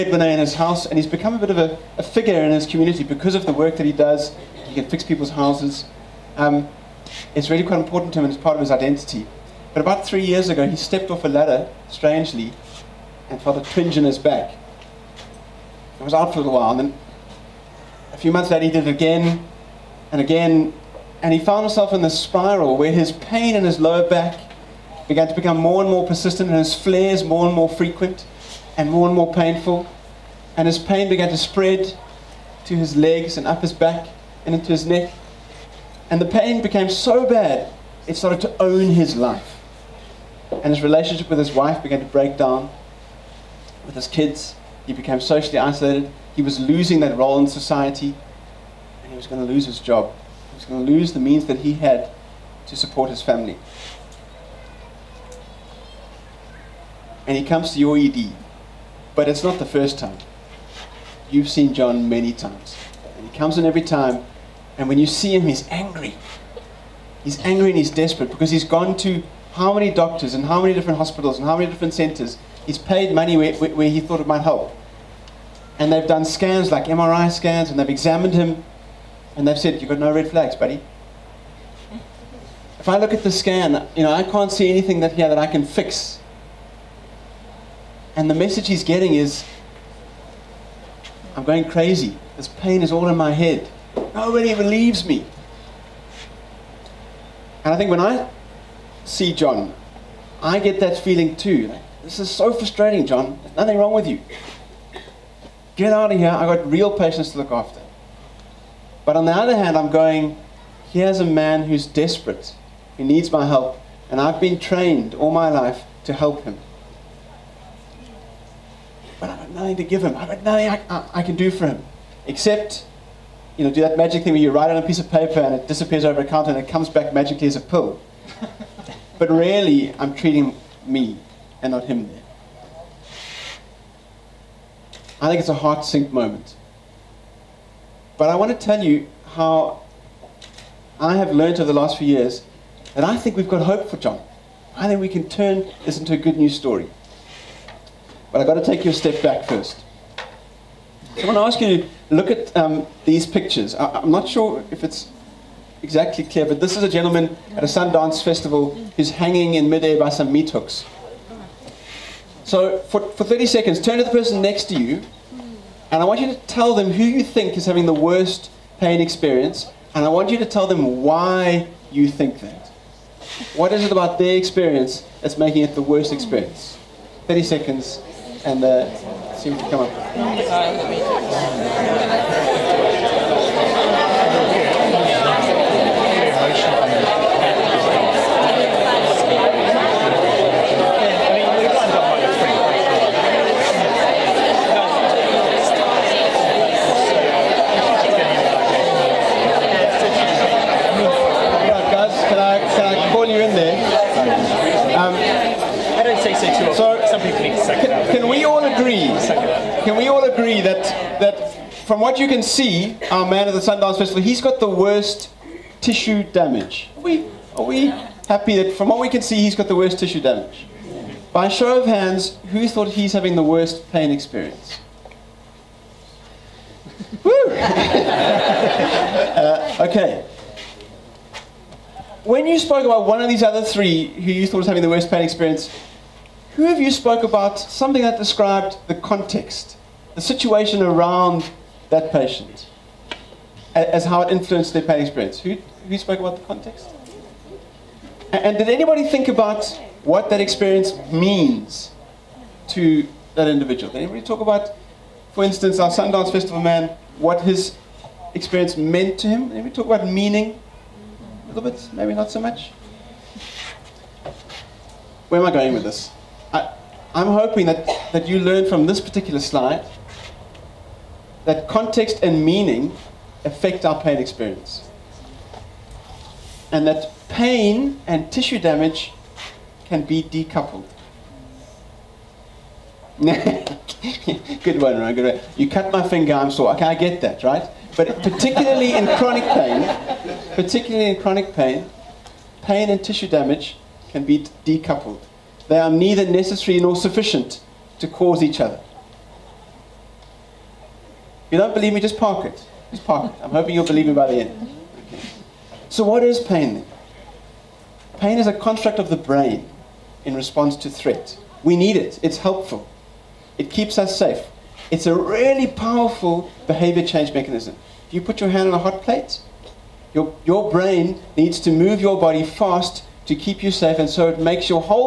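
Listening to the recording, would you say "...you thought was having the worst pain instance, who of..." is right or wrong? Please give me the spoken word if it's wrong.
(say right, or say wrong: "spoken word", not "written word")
wrong: "experience", not "instance".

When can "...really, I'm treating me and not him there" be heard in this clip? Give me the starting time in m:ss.
2:09.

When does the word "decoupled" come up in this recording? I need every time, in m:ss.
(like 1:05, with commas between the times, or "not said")
4:40, 4:54.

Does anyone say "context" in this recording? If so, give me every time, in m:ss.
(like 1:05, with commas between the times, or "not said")
3:58, 4:06, 4:31.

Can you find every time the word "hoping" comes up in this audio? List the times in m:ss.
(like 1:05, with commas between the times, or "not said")
4:27, 5:03.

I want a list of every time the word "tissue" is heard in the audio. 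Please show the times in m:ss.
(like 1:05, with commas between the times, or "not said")
3:35, 3:39, 4:38, 4:53.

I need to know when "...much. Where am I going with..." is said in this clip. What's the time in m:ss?
4:22.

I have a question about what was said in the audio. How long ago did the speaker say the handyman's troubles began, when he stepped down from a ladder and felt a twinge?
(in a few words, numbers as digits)
3 years ago.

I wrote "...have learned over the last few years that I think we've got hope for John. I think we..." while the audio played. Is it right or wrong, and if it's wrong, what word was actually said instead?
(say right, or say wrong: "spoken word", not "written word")
right.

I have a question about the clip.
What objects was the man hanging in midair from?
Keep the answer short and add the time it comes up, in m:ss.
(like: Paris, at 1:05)
Meat hooks, at 2:40.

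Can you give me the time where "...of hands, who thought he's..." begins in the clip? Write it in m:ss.
3:41.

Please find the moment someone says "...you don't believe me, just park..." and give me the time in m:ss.
5:01.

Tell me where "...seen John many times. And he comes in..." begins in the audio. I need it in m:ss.
1:01.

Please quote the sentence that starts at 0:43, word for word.
With his kids, he became socially isolated.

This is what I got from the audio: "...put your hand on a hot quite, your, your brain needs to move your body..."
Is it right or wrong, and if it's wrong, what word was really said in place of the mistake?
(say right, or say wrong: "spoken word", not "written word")
wrong: "plate", not "quite".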